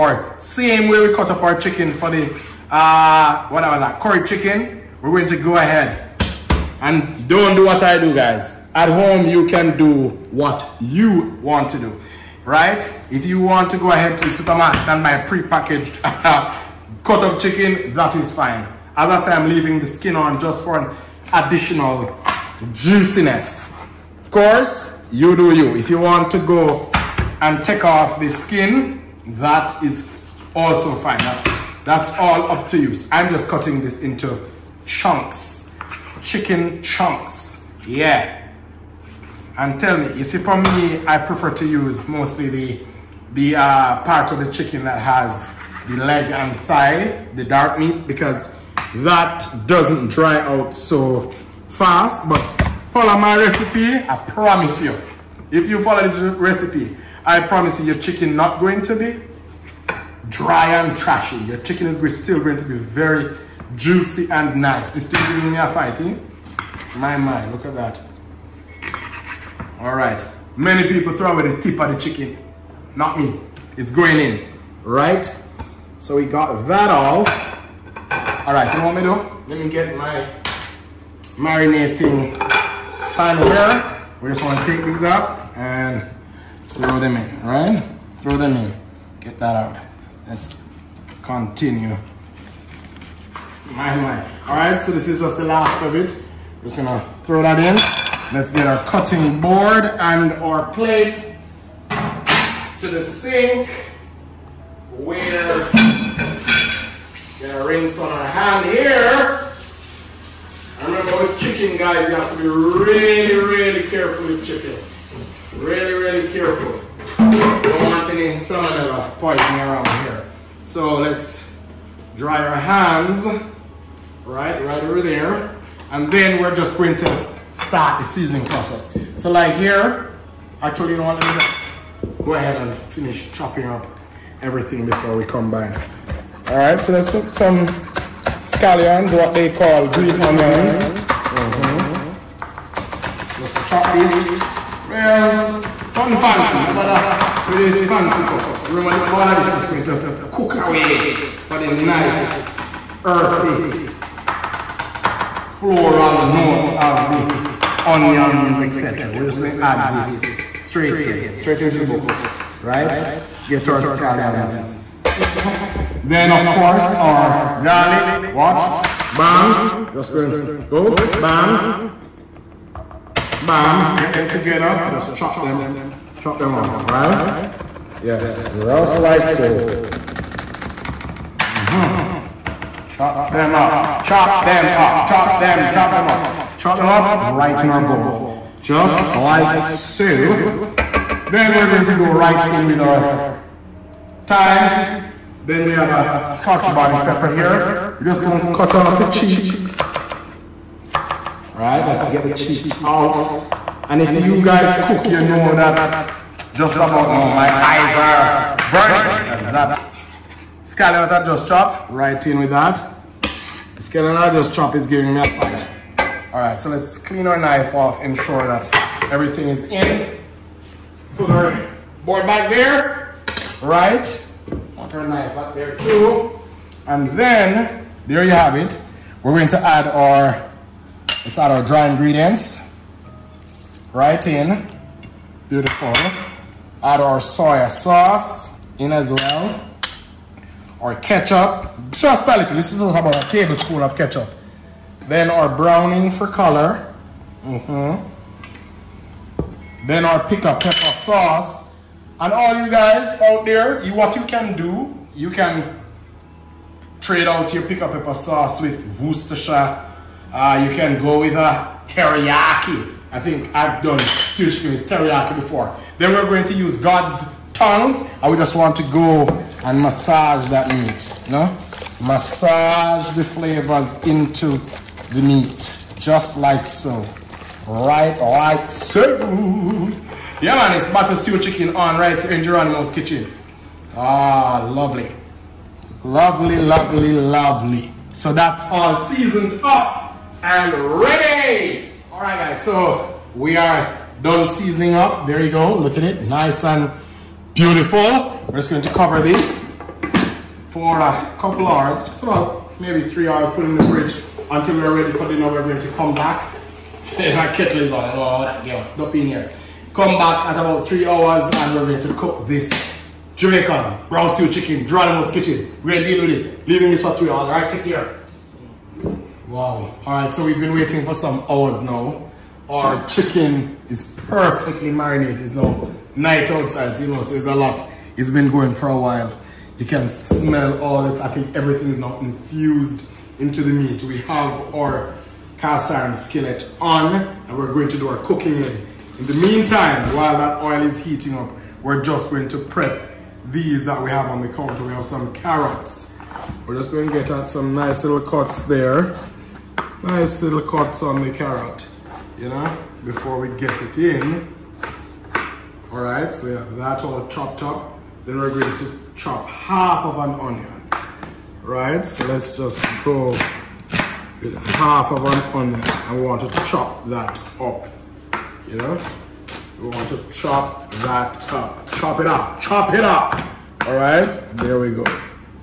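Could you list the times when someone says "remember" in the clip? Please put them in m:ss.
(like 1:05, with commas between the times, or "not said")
1:50, 2:28.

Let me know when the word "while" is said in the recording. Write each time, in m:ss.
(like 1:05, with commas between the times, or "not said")
5:28, 5:40.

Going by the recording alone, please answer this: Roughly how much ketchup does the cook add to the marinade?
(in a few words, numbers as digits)
1 tablespoon.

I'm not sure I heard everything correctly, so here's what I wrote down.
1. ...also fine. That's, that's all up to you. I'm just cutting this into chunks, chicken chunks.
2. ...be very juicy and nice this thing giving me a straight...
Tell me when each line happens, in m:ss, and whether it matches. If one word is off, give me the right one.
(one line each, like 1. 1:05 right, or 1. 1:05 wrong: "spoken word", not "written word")
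1. 0:30 right
2. 1:02 wrong: "fight", not "straight".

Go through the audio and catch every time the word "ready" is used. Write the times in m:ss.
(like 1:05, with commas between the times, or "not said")
4:51, 5:05.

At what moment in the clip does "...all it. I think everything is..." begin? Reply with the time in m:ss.
5:30.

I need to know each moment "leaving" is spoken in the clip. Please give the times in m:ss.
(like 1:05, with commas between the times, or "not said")
0:19, 5:16.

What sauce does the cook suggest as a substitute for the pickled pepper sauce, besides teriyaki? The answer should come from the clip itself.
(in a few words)
Worcestershire.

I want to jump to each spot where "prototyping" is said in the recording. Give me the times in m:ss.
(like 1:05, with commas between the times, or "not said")
not said.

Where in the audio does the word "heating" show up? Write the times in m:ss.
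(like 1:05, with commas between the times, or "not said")
5:41.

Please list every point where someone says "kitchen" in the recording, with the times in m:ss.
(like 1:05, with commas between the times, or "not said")
4:42, 5:15.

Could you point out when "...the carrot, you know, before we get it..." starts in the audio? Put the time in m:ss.
5:51.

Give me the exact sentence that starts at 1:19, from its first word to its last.
Let me get my marinating pan here.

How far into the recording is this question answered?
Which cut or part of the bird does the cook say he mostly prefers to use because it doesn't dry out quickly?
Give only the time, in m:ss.
0:46.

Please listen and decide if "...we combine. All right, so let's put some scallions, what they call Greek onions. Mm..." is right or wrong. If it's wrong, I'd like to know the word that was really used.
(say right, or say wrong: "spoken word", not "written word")
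right.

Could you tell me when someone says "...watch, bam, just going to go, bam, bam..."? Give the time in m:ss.
2:48.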